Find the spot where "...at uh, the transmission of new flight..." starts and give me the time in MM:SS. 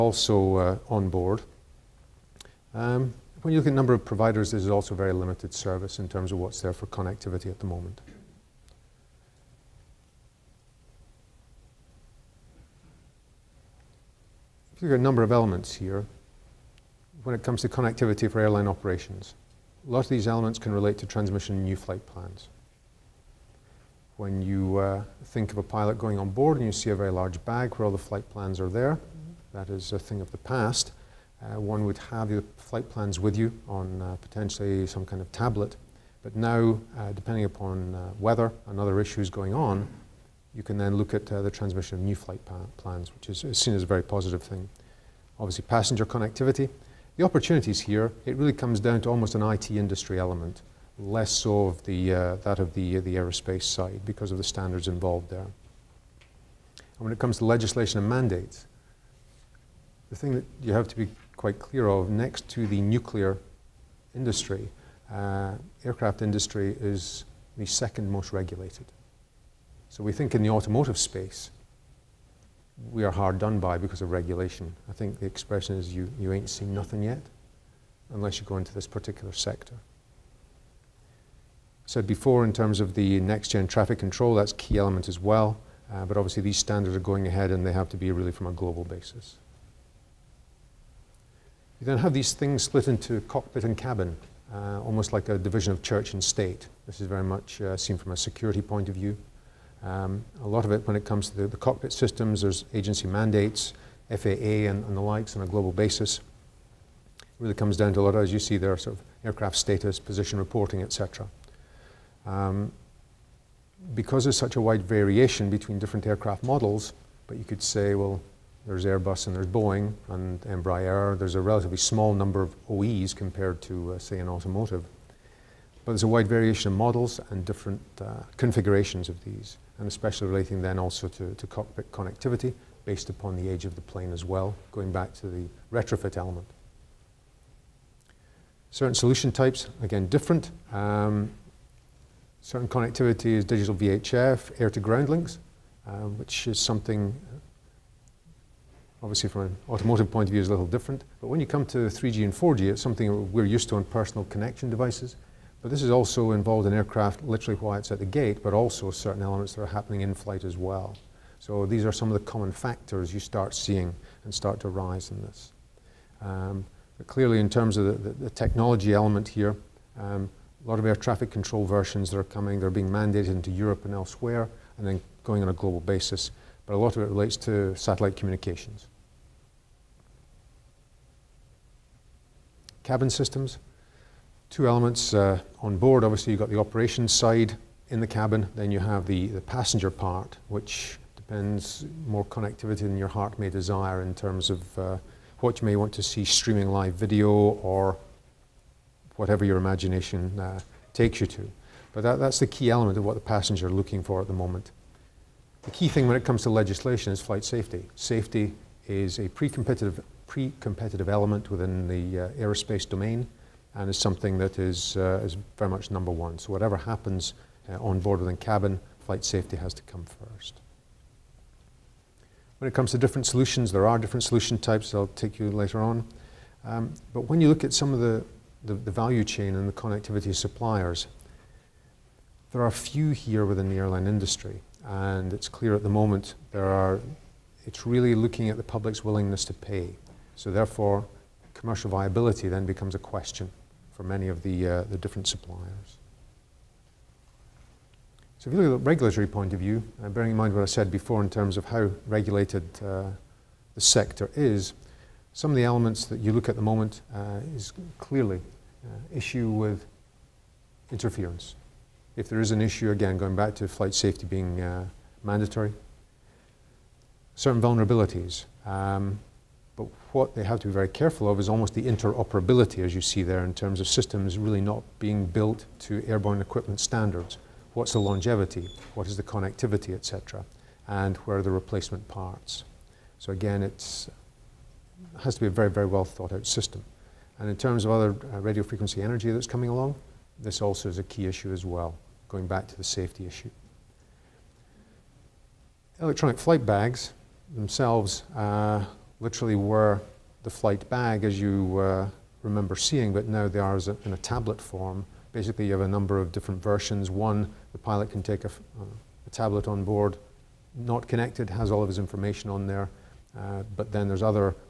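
00:41.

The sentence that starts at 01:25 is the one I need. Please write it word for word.
Uh, but obviously these standards are going ahead and they have to be really from a global basis.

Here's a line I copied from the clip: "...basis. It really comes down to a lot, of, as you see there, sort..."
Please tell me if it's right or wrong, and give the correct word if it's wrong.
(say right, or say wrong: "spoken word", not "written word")
right.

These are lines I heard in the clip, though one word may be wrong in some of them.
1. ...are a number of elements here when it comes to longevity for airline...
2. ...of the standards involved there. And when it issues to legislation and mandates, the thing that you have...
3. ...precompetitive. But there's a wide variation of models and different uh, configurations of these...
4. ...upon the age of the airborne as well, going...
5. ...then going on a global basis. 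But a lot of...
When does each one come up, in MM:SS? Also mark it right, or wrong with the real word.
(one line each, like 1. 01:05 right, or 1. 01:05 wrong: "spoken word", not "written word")
1. 00:14 wrong: "connectivity", not "longevity"
2. 00:54 wrong: "comes", not "issues"
3. 02:04 wrong: "automotive", not "precompetitive"
4. 02:13 wrong: "plane", not "airborne"
5. 02:54 right.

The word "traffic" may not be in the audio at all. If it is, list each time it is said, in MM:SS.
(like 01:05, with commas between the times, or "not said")
01:23, 02:50.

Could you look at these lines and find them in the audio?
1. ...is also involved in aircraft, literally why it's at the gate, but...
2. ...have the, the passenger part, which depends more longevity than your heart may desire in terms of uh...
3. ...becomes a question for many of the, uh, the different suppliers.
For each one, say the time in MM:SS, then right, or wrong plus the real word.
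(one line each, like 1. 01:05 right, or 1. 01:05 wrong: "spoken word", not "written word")
1. 02:35 right
2. 03:08 wrong: "connectivity", not "longevity"
3. 04:02 right.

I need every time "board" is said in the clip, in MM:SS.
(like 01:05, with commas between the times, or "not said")
00:01, 00:26, 03:05, 03:37, 05:09.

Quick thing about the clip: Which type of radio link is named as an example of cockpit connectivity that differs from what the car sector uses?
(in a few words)
Digital VHF.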